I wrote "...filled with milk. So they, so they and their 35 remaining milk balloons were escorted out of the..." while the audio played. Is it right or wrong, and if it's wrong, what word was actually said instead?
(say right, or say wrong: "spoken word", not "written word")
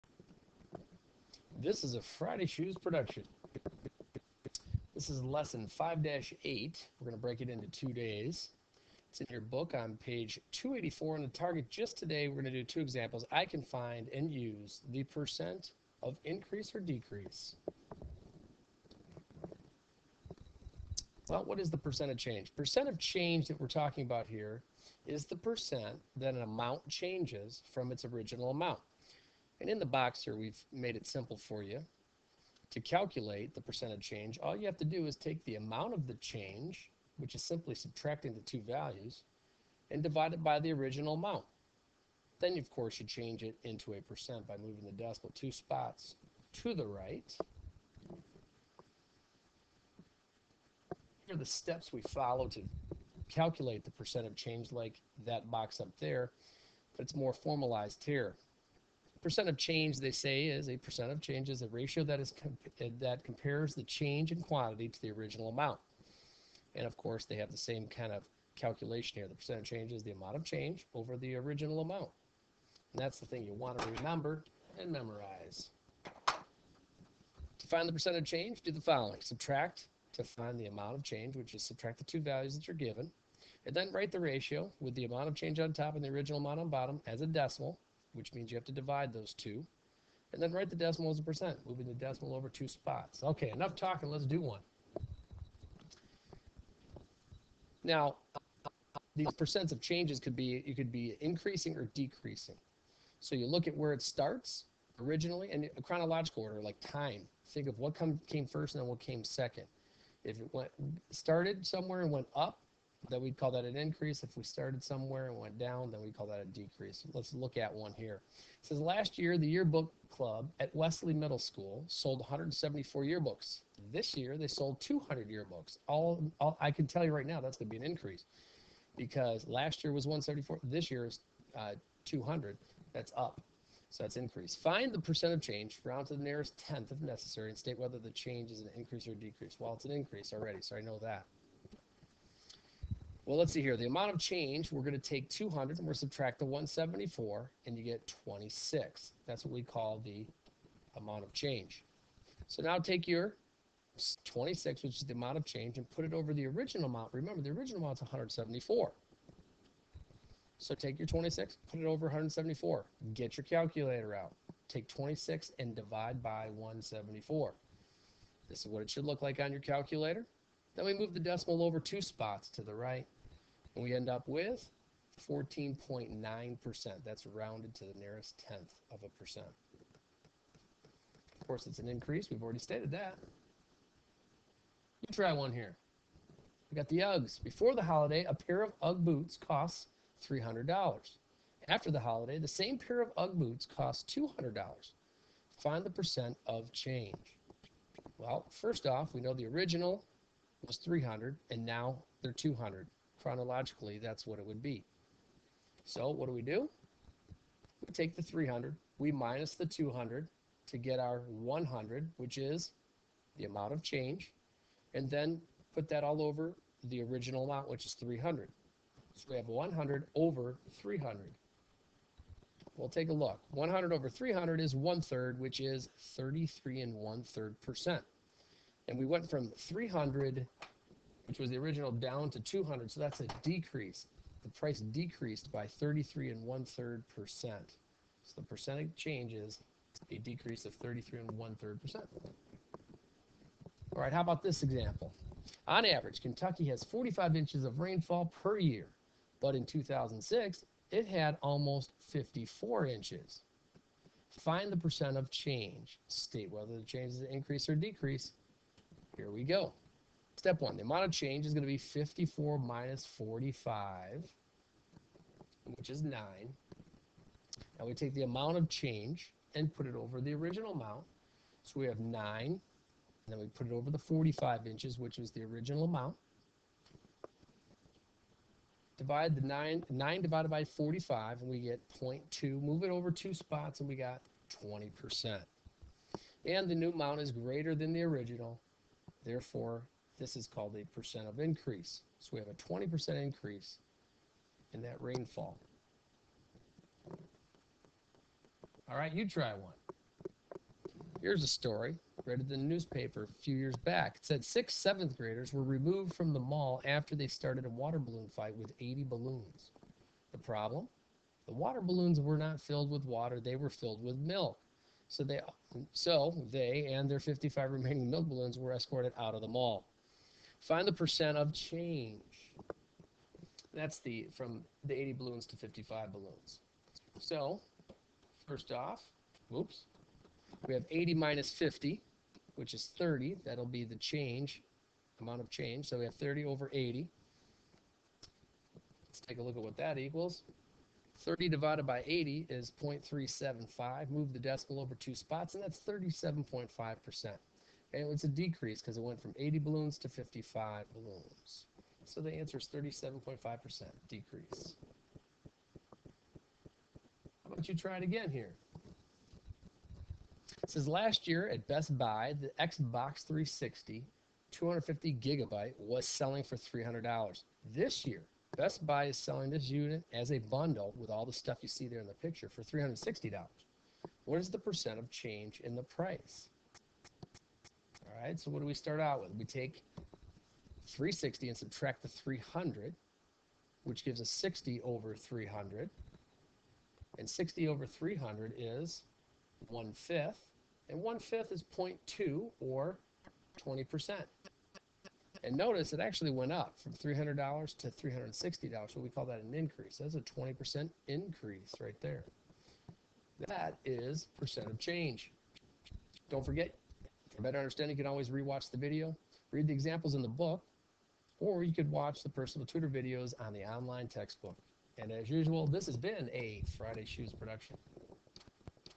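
wrong: "55", not "35".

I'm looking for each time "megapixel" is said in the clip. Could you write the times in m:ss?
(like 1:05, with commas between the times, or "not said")
not said.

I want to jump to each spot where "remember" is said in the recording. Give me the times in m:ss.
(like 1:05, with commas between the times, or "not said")
1:13, 2:37.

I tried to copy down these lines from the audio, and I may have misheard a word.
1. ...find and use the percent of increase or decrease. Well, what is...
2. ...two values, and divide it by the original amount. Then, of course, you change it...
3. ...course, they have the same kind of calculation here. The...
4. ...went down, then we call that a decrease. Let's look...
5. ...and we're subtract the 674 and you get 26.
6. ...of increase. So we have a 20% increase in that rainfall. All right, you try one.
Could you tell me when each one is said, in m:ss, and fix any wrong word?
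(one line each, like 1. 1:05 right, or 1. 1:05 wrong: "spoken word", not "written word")
1. 0:13 right
2. 0:38 right
3. 1:06 right
4. 1:55 right
5. 2:25 wrong: "174", not "674"
6. 4:51 right.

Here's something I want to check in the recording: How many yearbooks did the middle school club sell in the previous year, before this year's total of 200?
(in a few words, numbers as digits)
174.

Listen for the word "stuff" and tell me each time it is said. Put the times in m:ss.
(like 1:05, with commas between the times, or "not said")
6:11.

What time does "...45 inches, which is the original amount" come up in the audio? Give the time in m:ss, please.
4:33.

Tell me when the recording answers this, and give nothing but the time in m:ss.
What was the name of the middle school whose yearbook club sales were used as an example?
2:00.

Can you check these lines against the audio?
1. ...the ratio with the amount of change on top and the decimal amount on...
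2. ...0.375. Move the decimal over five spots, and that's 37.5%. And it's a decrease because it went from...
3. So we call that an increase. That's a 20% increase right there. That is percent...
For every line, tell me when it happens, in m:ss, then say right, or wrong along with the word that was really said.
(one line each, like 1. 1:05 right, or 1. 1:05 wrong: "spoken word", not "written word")
1. 1:24 wrong: "original", not "decimal"
2. 5:42 wrong: "two", not "five"
3. 6:38 right.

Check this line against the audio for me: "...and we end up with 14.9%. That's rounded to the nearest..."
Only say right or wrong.
right.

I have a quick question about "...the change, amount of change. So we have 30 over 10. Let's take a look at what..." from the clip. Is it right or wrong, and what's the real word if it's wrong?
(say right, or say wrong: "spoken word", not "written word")
wrong: "80", not "10".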